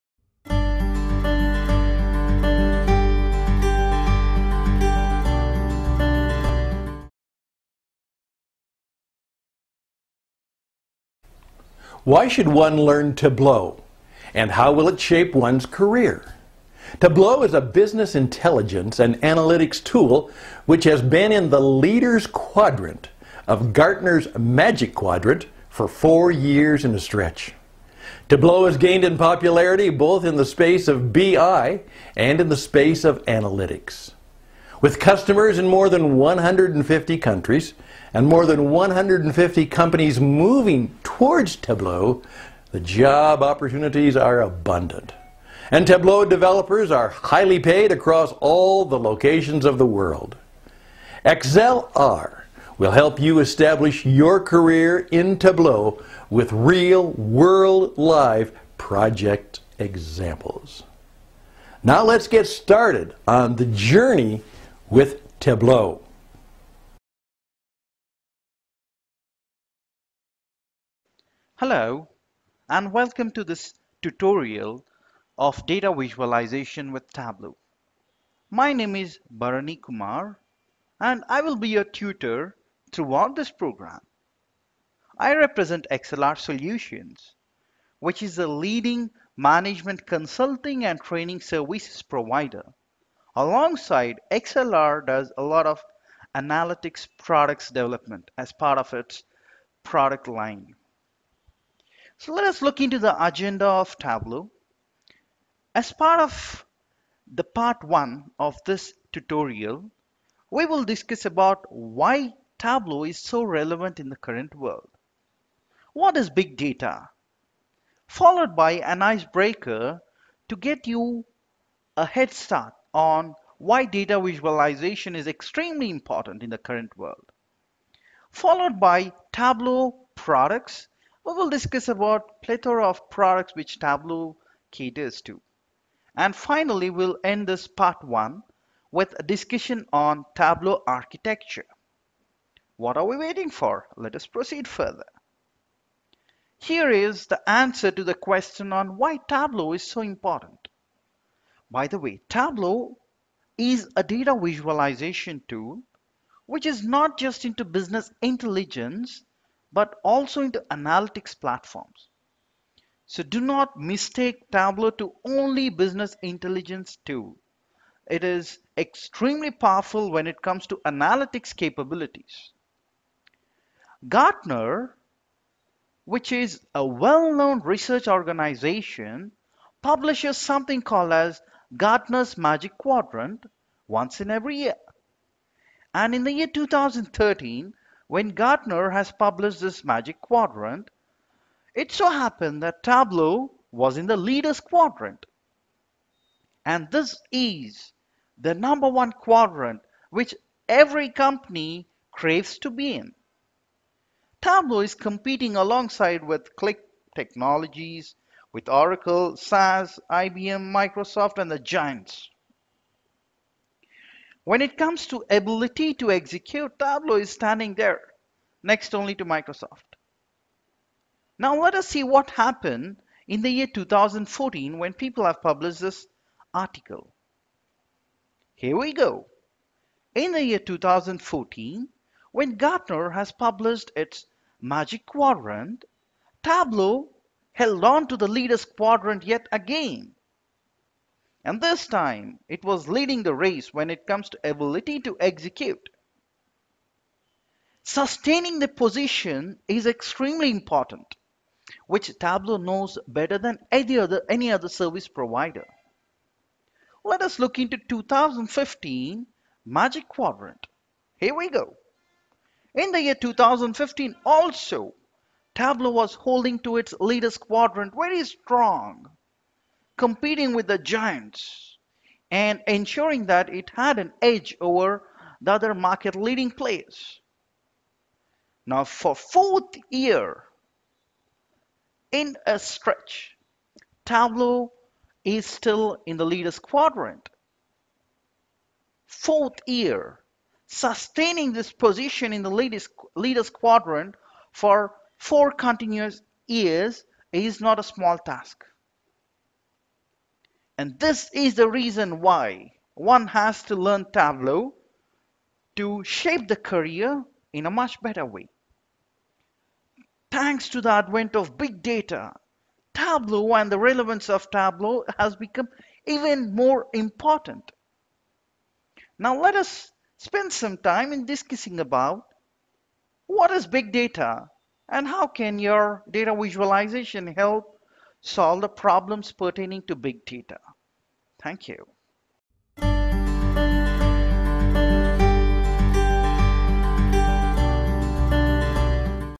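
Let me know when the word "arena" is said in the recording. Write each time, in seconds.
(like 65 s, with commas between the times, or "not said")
not said.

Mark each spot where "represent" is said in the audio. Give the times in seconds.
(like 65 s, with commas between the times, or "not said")
85 s.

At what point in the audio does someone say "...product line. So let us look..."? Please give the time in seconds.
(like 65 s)
99 s.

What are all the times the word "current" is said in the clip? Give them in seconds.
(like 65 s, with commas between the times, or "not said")
114 s, 126 s.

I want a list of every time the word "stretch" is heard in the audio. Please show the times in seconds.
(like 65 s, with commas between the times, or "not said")
26 s, 282 s.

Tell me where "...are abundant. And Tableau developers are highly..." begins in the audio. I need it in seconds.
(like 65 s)
44 s.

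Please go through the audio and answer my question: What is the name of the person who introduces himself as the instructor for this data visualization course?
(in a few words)
Bharani Kumar.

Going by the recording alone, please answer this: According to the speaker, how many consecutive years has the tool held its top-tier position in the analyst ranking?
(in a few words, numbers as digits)
4.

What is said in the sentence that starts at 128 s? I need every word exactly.
Followed by Tableau products we will discuss about plethora of products which Tableau caters to.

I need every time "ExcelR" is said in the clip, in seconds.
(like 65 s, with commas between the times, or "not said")
51 s, 85 s, 94 s.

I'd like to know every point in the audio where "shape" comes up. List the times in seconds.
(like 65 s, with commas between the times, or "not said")
14 s, 306 s.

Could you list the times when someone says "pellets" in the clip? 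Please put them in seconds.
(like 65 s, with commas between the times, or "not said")
not said.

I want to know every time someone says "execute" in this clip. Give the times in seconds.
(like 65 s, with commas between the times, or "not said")
216 s, 245 s.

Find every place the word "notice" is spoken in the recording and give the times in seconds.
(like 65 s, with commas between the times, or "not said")
not said.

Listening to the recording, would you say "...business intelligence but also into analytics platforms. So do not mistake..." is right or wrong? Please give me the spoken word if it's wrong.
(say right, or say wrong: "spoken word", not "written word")
right.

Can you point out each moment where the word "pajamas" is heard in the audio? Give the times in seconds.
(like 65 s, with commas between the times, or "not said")
not said.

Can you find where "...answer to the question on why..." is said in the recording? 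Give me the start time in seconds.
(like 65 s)
147 s.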